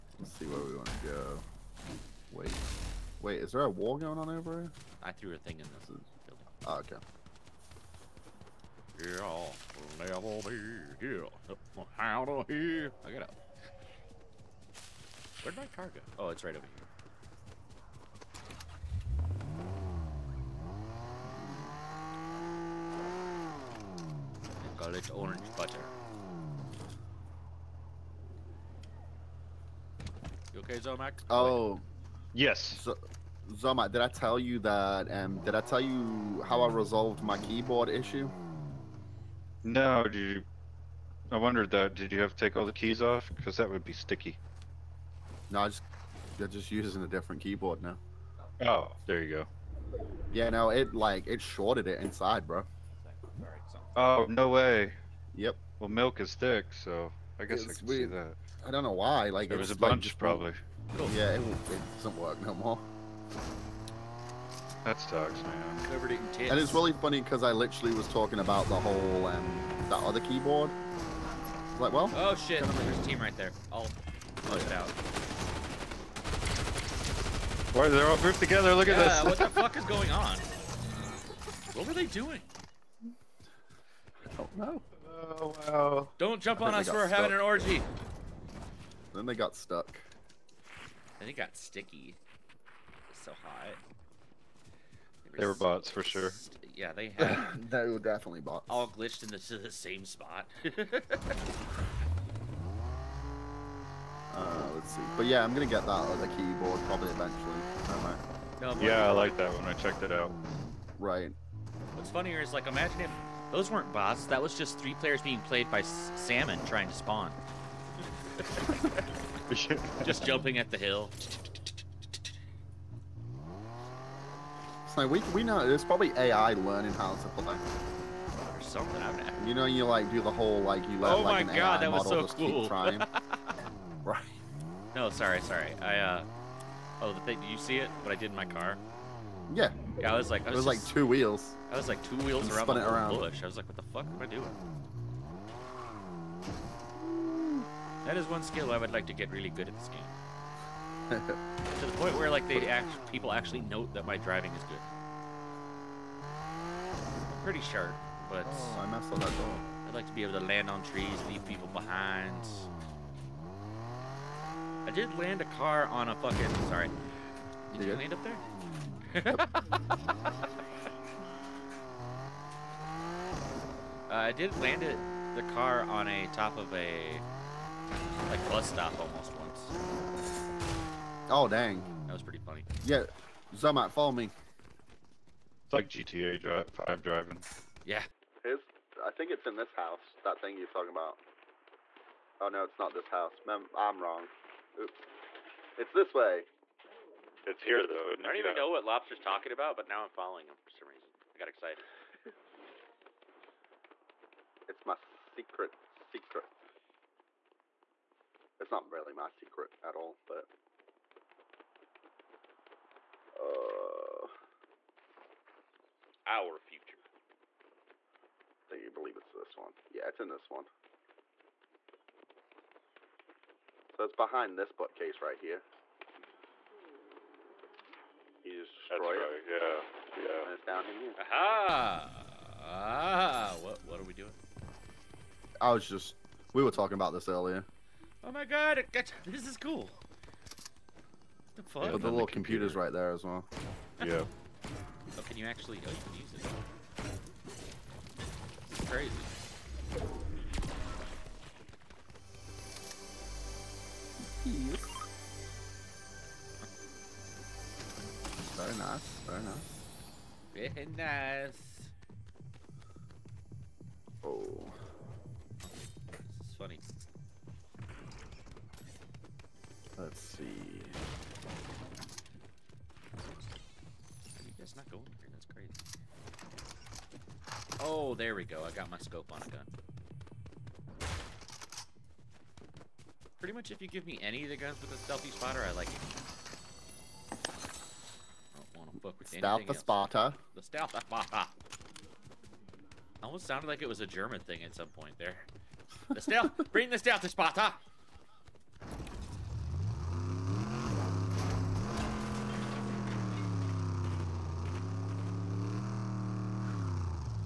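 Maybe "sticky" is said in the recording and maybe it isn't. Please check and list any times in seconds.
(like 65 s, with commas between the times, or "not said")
43 s, 91 s.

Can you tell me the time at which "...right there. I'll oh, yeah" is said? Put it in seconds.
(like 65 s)
73 s.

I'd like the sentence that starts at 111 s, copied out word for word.
What's funnier is like imagine if those weren't bots.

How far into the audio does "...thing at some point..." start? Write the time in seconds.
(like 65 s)
294 s.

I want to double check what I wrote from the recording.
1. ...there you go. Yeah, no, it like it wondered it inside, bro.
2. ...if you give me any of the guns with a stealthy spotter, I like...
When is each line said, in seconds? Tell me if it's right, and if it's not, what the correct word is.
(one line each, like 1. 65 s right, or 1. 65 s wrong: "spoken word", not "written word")
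1. 49 s wrong: "shorted", not "wondered"
2. 283 s right.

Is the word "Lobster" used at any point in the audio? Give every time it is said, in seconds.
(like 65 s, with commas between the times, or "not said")
198 s.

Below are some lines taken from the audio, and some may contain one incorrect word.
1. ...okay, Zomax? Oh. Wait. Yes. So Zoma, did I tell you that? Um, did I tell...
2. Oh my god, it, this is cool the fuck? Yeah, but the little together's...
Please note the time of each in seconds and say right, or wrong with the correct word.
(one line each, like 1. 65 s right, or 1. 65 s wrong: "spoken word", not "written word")
1. 30 s right
2. 238 s wrong: "computer", not "together".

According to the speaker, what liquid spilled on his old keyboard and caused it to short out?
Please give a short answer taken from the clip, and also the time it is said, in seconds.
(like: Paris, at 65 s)
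Milk, at 55 s.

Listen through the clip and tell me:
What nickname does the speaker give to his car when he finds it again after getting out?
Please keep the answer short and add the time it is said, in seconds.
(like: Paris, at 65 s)
Orange butter, at 25 s.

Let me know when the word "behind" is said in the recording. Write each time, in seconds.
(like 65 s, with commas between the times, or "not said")
161 s, 224 s.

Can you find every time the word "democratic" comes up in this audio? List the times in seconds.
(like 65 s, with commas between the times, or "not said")
not said.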